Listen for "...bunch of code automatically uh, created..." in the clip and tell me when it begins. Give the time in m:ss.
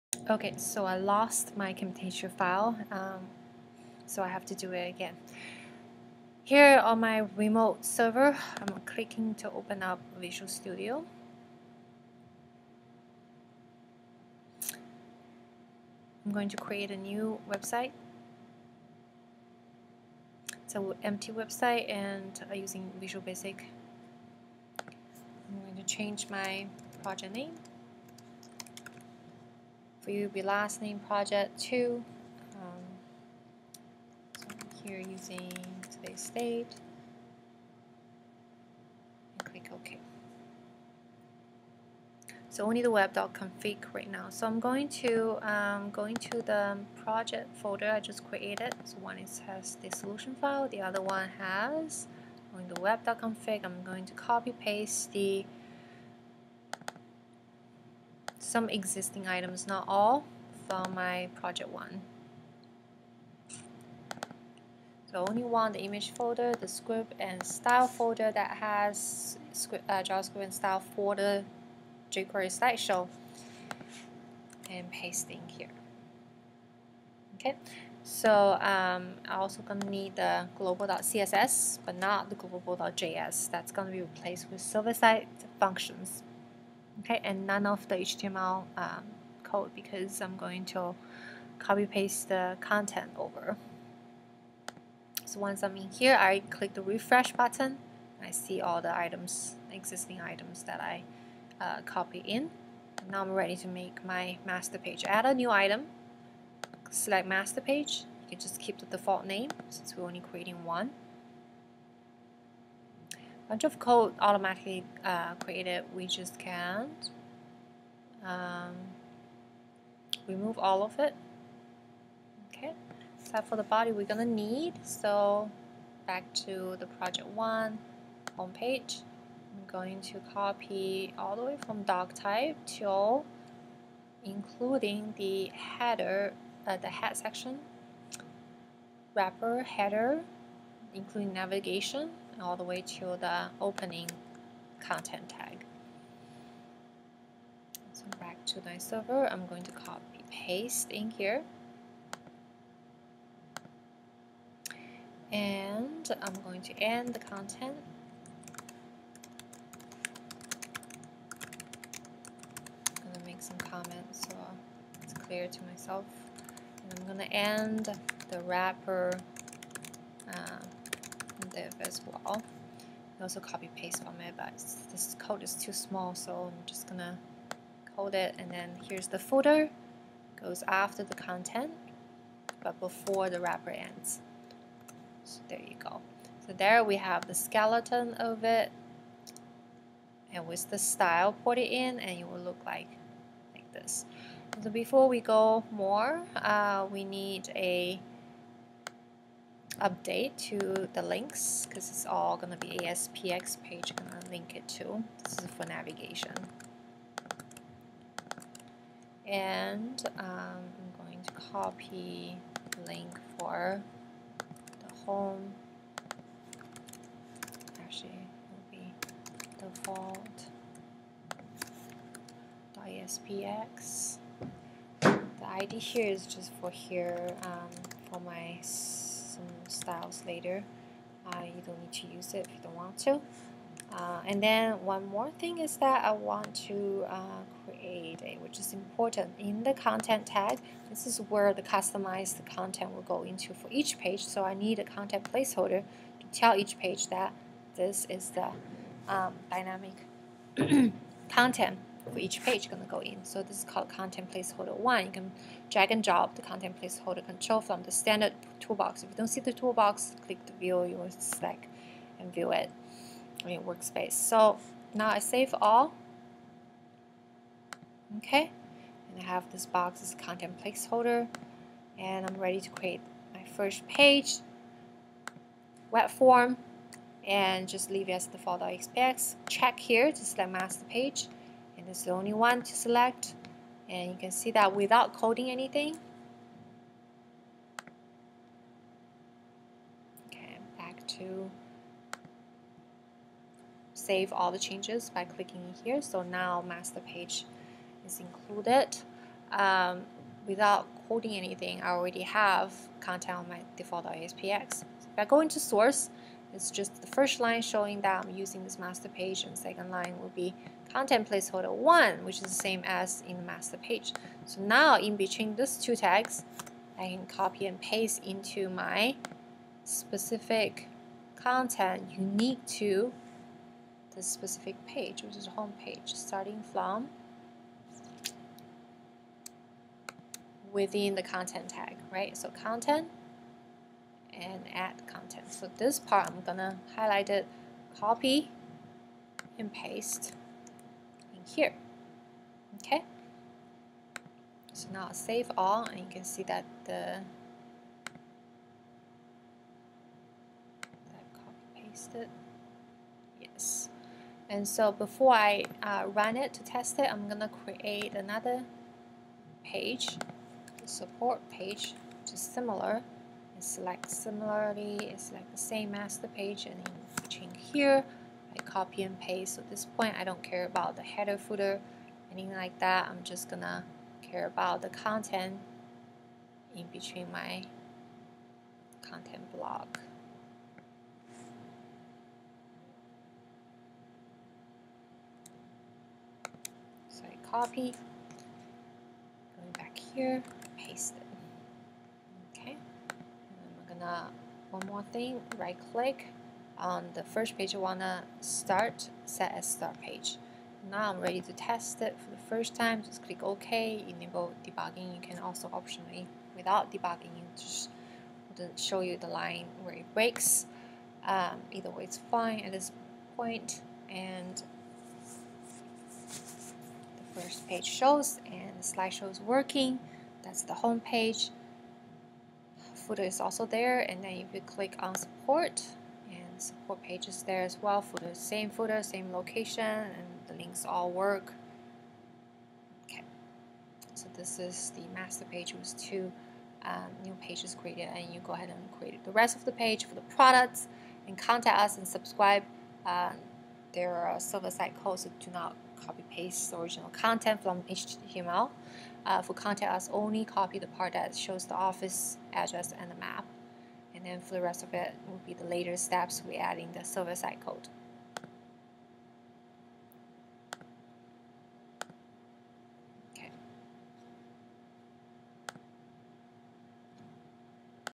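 1:53.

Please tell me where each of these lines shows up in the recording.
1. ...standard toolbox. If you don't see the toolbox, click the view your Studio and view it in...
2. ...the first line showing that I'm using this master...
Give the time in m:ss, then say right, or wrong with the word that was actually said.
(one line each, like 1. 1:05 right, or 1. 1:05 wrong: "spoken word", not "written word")
1. 4:17 wrong: "Slack", not "Studio"
2. 5:06 right.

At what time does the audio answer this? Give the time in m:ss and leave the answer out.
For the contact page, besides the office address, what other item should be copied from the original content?
7:33.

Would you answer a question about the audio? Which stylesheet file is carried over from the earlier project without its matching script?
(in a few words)
global.css.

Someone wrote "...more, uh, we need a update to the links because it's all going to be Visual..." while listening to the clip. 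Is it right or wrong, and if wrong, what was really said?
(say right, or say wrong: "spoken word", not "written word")
wrong: "ASPX", not "Visual".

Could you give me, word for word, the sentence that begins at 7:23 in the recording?
Uh, there are server-side codes so do not copy paste the original content from HTML.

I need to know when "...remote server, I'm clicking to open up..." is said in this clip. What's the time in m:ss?
0:07.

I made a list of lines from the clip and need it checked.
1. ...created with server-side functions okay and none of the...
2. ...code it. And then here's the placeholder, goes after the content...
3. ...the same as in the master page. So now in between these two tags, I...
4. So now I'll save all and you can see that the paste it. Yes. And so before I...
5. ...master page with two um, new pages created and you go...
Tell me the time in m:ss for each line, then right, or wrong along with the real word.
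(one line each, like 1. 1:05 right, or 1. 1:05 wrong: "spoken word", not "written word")
1. 1:24 wrong: "replaced", not "created"
2. 2:57 wrong: "footer", not "placeholder"
3. 5:12 right
4. 5:44 right
5. 7:15 right.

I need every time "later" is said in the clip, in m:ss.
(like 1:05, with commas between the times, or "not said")
3:50, 7:35.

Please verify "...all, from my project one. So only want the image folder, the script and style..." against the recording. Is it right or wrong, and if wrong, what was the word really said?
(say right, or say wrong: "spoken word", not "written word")
right.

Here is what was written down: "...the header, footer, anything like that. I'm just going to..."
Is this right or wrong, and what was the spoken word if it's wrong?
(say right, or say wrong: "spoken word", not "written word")
right.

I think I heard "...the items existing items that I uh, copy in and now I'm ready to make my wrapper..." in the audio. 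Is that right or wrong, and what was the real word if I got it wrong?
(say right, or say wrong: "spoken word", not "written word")
wrong: "master", not "wrapper".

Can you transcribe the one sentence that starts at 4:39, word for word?
Check here to select master page, and it's the only one to select.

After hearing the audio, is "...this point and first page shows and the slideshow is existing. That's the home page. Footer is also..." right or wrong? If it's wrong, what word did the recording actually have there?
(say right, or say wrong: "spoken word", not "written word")
wrong: "working", not "existing".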